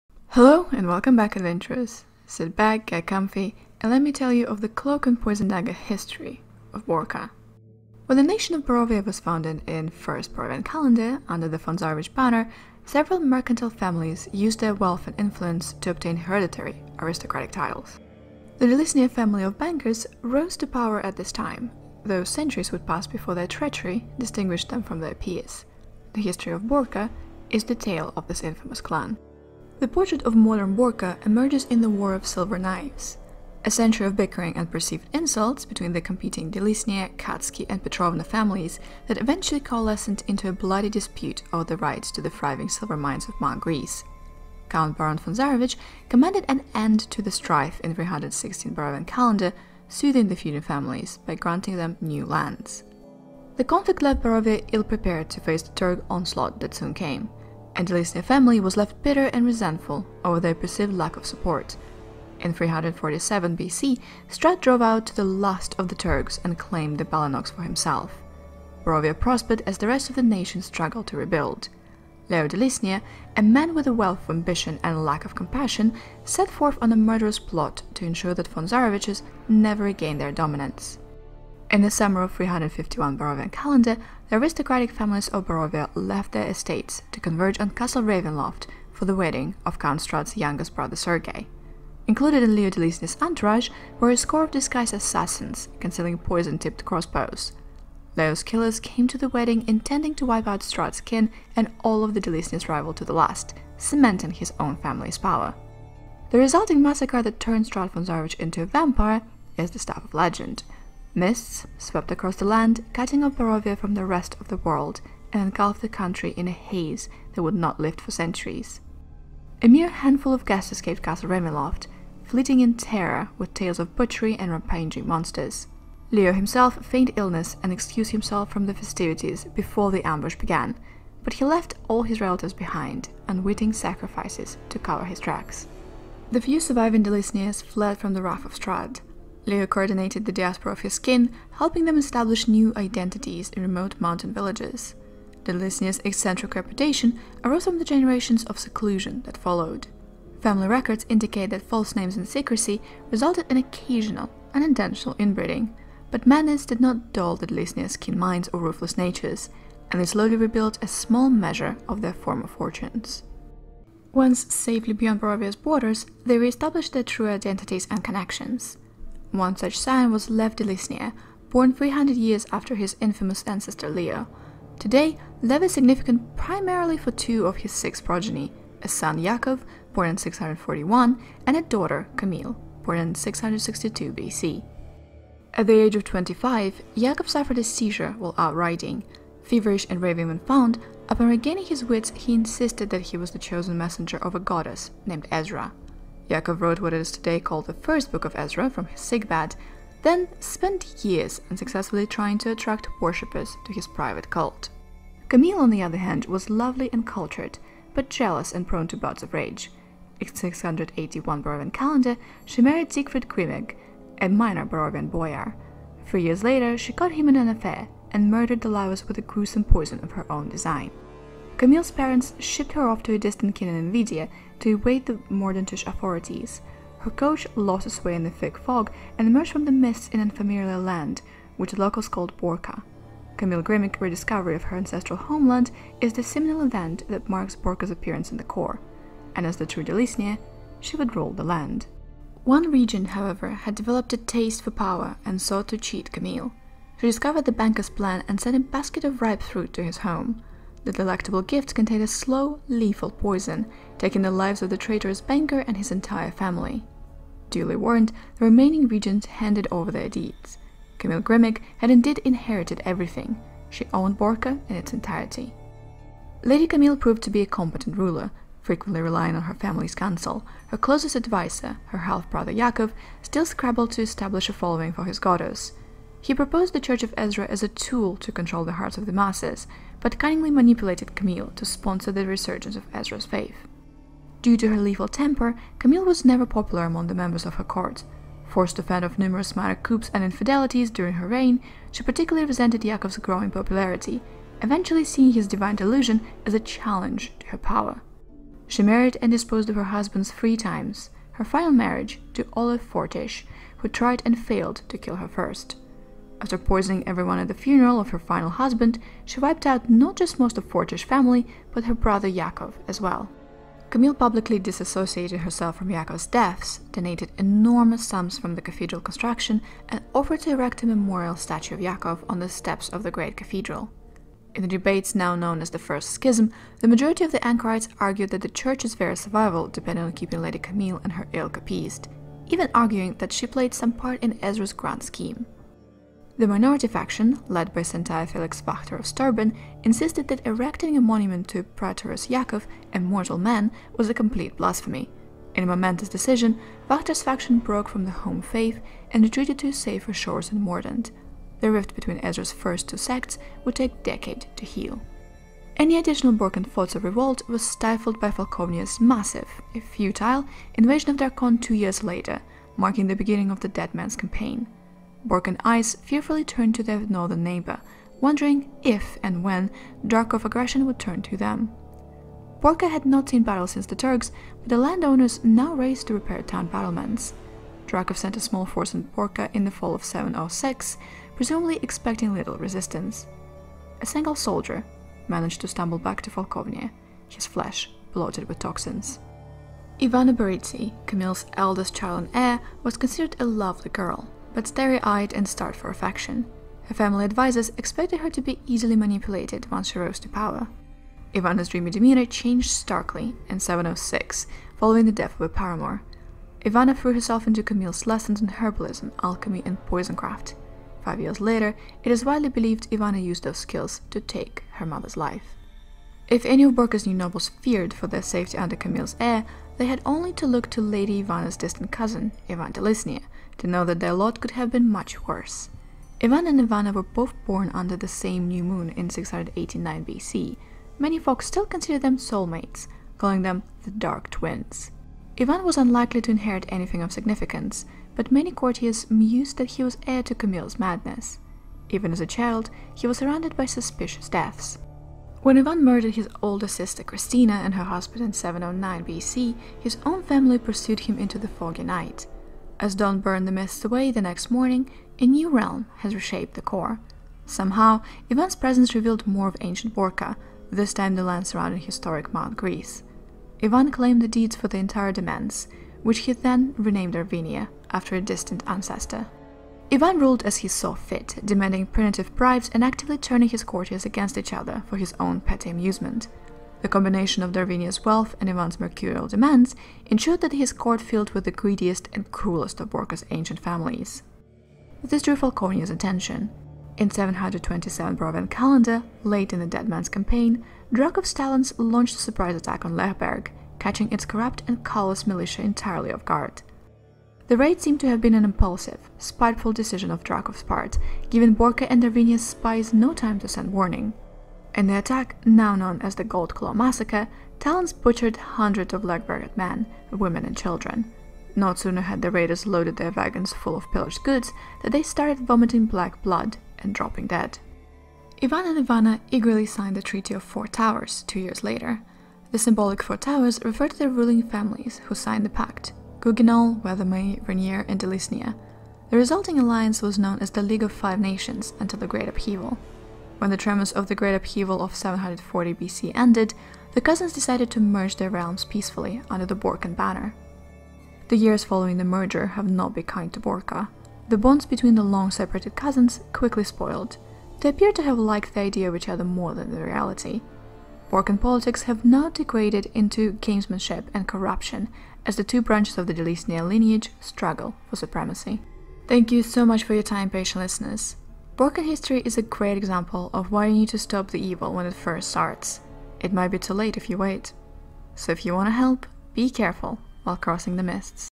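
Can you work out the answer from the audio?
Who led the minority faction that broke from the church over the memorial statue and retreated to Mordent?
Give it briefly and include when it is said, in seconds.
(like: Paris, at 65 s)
Felix Pachter, at 338 s.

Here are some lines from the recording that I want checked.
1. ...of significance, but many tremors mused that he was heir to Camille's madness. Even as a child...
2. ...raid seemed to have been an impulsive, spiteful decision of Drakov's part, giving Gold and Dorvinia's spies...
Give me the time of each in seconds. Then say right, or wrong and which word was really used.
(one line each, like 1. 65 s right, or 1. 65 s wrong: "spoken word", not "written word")
1. 437 s wrong: "courtiers", not "tremors"
2. 497 s wrong: "Borca", not "Gold".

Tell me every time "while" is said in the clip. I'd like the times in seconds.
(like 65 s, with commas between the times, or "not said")
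188 s, 570 s.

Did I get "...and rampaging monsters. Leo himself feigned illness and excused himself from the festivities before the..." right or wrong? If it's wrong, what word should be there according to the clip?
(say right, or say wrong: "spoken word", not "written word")
right.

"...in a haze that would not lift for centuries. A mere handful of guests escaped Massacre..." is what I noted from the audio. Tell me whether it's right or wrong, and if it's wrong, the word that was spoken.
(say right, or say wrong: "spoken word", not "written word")
wrong: "Castle", not "Massacre".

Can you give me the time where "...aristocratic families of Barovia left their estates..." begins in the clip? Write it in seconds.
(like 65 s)
84 s.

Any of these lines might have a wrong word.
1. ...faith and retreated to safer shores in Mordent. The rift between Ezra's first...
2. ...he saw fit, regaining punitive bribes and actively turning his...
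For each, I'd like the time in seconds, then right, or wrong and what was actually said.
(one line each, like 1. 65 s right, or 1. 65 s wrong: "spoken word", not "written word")
1. 348 s right
2. 470 s wrong: "demanding", not "regaining".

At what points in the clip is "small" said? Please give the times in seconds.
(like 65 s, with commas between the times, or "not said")
160 s, 378 s.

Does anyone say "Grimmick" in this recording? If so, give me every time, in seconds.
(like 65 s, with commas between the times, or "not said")
233 s, 261 s.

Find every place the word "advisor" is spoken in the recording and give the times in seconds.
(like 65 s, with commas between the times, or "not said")
271 s, 397 s.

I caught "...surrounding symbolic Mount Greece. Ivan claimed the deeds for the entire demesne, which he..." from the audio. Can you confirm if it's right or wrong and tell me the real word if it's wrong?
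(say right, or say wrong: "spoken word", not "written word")
wrong: "historic", not "symbolic".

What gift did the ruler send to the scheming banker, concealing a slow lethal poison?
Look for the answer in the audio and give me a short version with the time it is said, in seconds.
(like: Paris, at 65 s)
A basket of ripe fruit, at 248 s.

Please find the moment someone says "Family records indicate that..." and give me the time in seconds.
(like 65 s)
150 s.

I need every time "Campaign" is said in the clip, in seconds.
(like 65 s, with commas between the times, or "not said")
364 s, 490 s.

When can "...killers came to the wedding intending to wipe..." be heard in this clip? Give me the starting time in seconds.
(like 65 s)
98 s.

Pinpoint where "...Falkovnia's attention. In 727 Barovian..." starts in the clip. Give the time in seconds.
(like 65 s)
485 s.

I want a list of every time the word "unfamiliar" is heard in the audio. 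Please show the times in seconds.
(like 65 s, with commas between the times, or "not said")
230 s.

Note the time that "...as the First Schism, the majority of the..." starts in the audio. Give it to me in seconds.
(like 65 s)
325 s.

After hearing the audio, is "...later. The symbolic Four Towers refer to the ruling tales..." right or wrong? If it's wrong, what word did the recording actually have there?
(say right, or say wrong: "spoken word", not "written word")
wrong: "families", not "tales".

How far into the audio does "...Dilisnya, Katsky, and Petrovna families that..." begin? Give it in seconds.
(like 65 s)
36 s.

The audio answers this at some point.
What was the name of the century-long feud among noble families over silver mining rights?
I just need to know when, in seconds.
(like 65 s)
31 s.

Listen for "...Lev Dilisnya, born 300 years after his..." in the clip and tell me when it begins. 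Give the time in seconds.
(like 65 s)
170 s.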